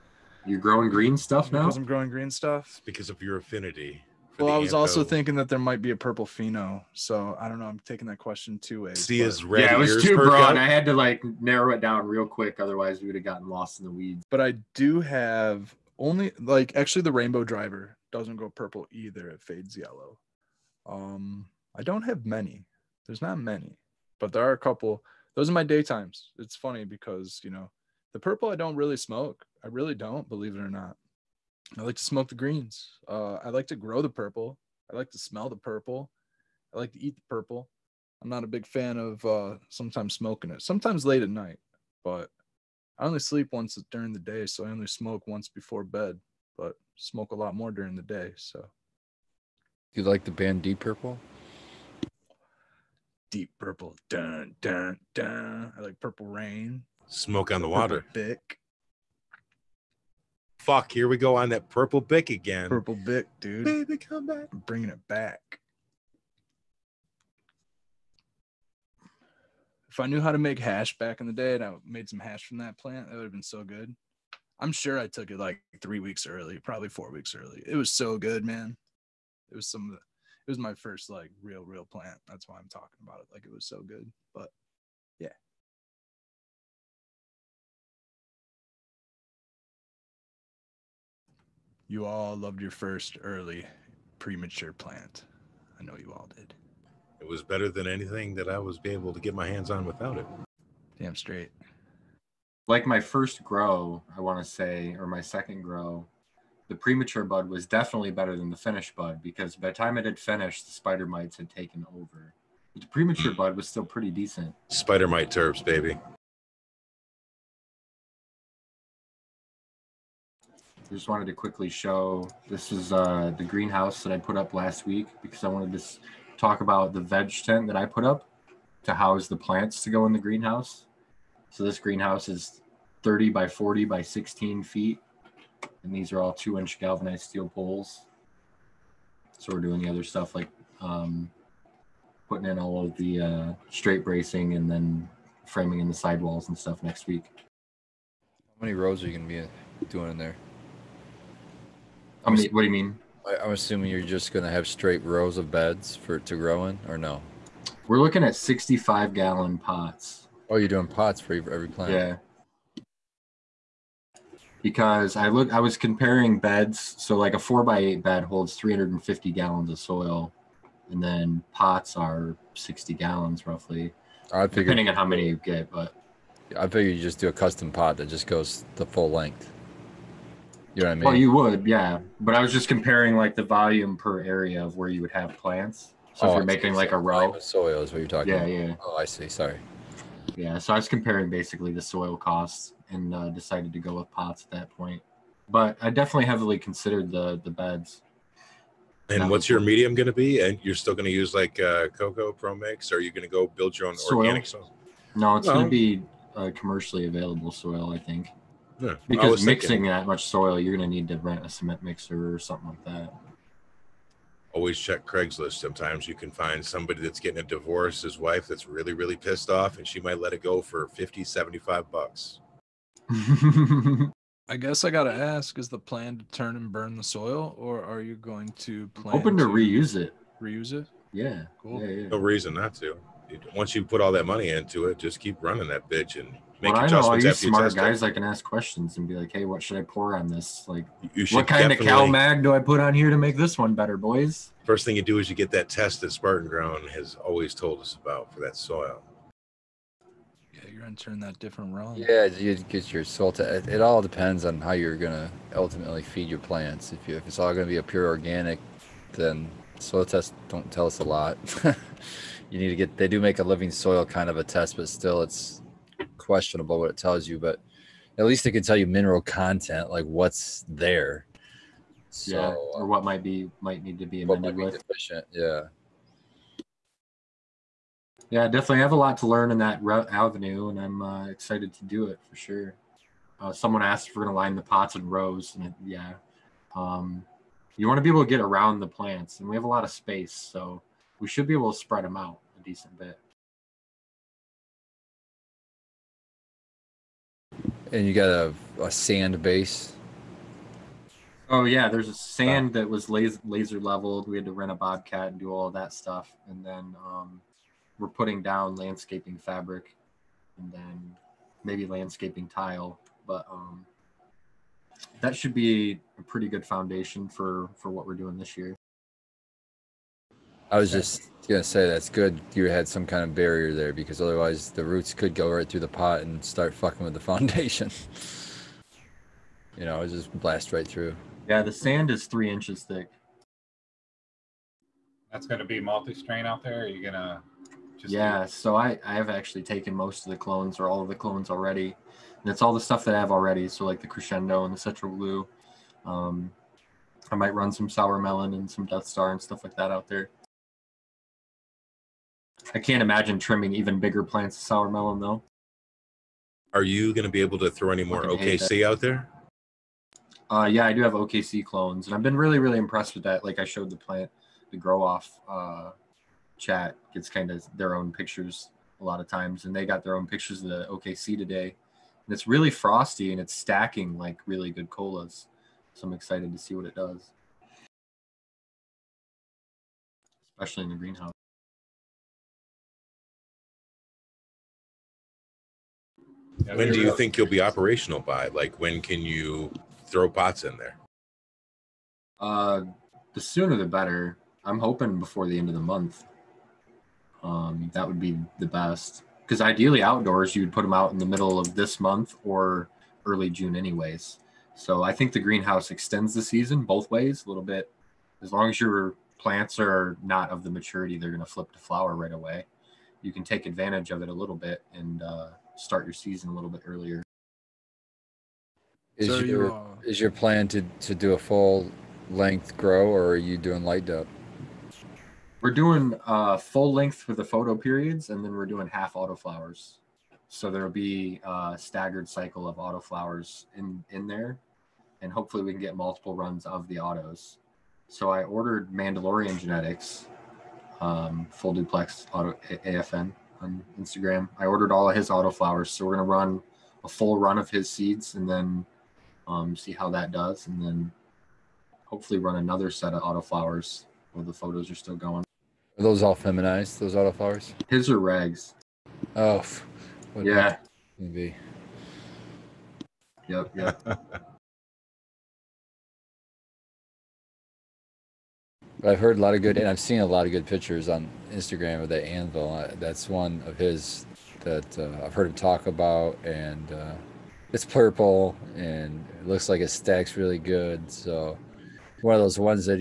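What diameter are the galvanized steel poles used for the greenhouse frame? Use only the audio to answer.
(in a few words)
2 inch.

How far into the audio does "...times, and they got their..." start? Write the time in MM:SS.
06:09.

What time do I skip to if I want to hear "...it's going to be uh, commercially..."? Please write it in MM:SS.
03:25.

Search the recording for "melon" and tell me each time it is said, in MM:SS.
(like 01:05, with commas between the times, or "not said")
05:48, 05:54.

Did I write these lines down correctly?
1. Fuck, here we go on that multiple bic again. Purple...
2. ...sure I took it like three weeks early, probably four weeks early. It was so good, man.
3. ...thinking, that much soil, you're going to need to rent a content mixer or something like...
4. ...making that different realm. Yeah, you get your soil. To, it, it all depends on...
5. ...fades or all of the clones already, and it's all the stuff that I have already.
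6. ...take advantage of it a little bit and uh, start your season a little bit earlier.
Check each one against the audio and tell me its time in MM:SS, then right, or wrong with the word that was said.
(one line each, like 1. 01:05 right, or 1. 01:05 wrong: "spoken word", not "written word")
1. 01:00 wrong: "purple", not "multiple"
2. 01:14 right
3. 03:29 wrong: "cement", not "content"
4. 04:10 wrong: "entering", not "making"
5. 05:40 wrong: "clones", not "fades"
6. 06:53 right.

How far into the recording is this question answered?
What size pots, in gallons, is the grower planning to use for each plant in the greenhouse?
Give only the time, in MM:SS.
02:38.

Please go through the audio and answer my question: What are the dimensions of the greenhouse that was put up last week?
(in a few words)
30 by 40 by 16 feet.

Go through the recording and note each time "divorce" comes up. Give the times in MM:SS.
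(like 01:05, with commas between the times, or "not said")
03:37.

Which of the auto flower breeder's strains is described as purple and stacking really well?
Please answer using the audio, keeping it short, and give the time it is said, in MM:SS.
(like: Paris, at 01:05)
anvil, at 07:52.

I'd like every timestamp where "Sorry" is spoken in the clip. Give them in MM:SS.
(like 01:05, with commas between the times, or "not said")
03:09.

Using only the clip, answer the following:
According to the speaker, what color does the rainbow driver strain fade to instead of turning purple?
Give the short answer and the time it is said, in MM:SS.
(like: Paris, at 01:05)
yellow, at 00:19.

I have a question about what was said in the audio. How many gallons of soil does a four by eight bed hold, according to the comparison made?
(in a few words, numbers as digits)
350 gallons.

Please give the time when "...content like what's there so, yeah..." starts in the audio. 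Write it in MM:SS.
04:29.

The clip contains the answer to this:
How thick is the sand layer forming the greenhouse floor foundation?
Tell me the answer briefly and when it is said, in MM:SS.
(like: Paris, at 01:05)
3 inches, at 05:32.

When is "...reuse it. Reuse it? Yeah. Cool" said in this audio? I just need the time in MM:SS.
03:49.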